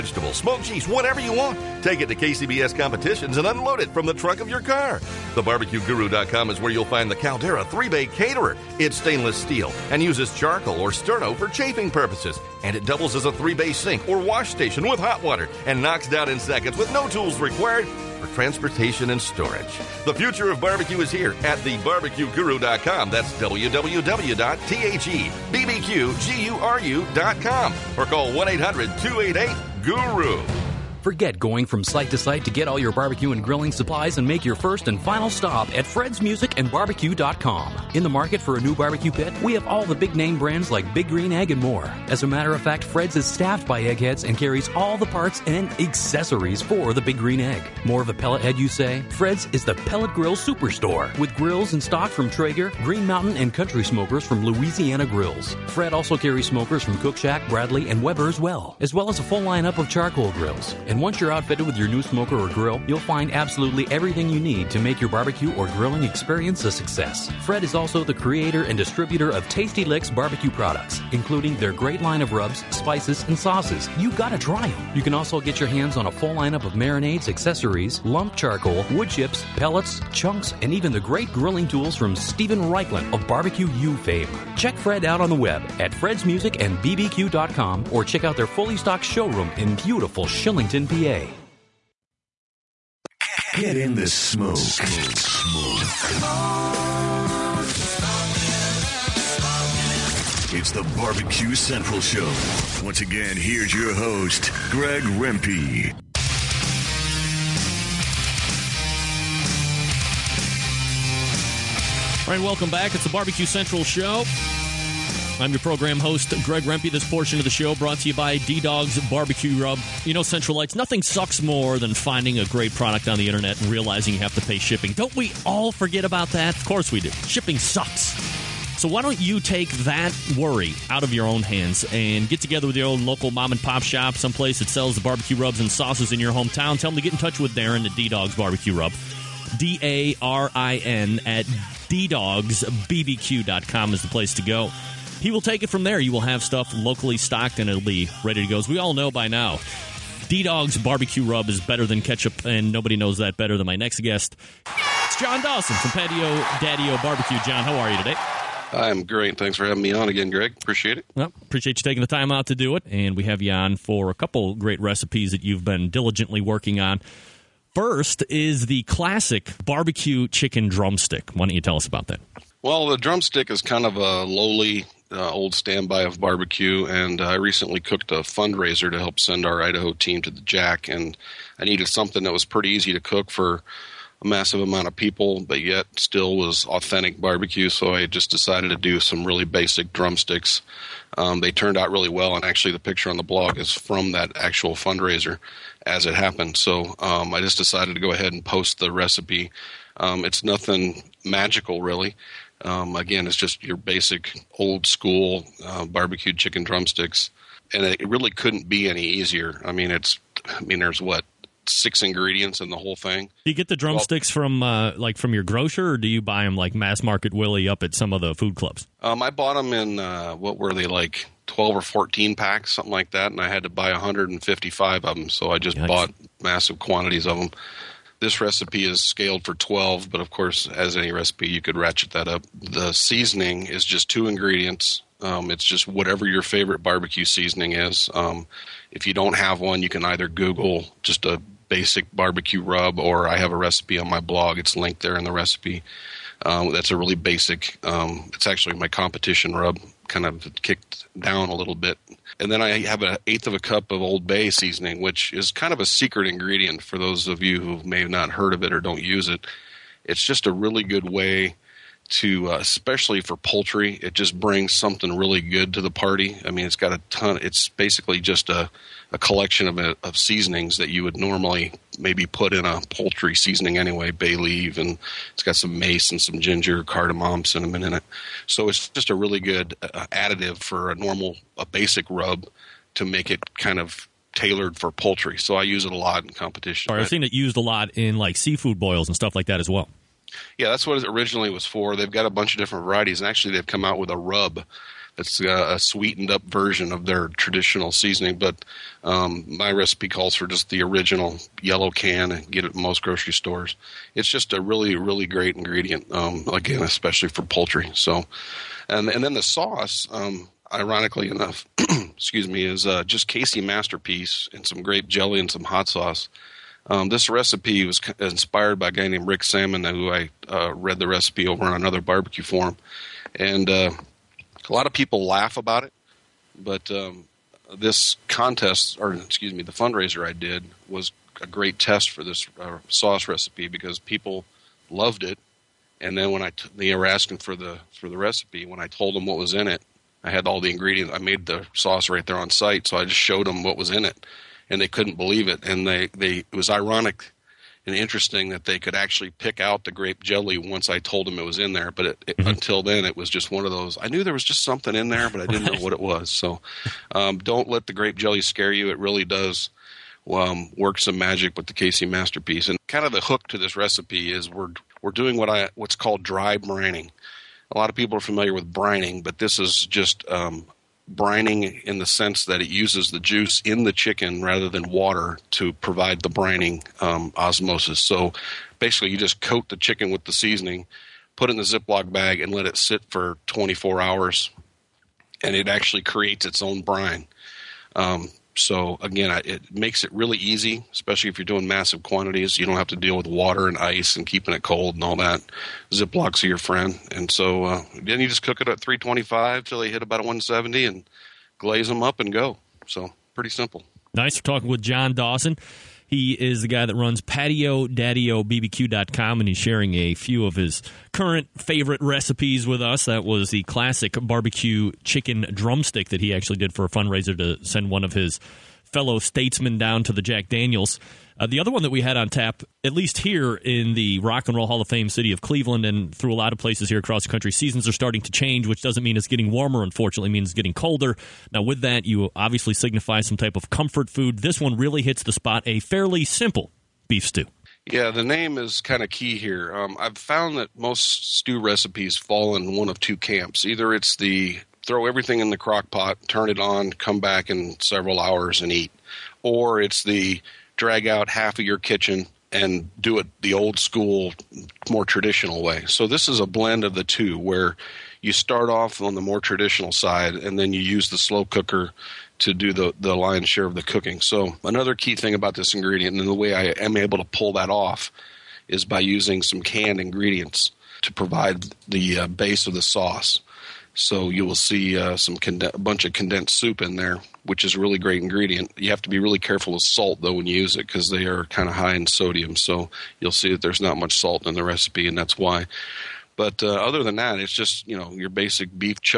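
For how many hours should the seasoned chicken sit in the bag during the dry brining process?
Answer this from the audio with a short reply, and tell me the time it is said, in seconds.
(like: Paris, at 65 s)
24, at 383 s.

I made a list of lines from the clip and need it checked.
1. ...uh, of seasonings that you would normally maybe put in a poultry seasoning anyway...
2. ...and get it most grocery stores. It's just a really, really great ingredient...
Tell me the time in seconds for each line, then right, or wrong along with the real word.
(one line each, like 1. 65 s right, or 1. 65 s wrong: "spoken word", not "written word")
1. 269 s right
2. 302 s right.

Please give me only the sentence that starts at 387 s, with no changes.
Um, so again, I, it makes it really easy, especially if you're doing massive quantities.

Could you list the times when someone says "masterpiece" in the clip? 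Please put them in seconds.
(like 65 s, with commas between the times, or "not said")
313 s, 362 s.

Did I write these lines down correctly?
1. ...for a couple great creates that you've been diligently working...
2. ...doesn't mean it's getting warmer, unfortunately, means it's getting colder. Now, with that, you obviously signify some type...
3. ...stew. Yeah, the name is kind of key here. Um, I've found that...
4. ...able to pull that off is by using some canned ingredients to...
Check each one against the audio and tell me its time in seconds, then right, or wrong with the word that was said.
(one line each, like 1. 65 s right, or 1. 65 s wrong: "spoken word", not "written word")
1. 163 s wrong: "recipes", not "creates"
2. 428 s right
3. 437 s right
4. 466 s right.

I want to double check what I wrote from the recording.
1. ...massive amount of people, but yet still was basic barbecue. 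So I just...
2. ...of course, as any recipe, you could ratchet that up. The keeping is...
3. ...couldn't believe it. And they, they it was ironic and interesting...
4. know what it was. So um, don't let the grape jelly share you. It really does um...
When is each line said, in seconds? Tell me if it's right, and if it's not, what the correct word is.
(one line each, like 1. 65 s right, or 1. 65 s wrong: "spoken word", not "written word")
1. 184 s wrong: "authentic", not "basic"
2. 230 s wrong: "seasoning", not "keeping"
3. 344 s right
4. 355 s wrong: "scare", not "share".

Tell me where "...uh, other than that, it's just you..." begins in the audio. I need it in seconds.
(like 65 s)
486 s.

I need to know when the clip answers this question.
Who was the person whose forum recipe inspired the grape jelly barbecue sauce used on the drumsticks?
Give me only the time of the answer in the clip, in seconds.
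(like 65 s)
319 s.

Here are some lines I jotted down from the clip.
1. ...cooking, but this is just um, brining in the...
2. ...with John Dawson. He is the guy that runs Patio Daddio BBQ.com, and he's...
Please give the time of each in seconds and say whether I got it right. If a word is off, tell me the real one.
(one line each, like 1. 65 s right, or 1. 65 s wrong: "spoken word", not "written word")
1. 368 s wrong: "brining", not "cooking"
2. 404 s right.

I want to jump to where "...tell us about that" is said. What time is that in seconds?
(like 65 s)
171 s.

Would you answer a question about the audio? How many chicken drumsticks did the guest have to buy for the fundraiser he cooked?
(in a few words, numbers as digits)
155.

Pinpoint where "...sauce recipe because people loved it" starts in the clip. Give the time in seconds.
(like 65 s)
332 s.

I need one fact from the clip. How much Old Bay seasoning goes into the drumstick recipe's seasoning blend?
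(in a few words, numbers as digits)
an eighth of a cup.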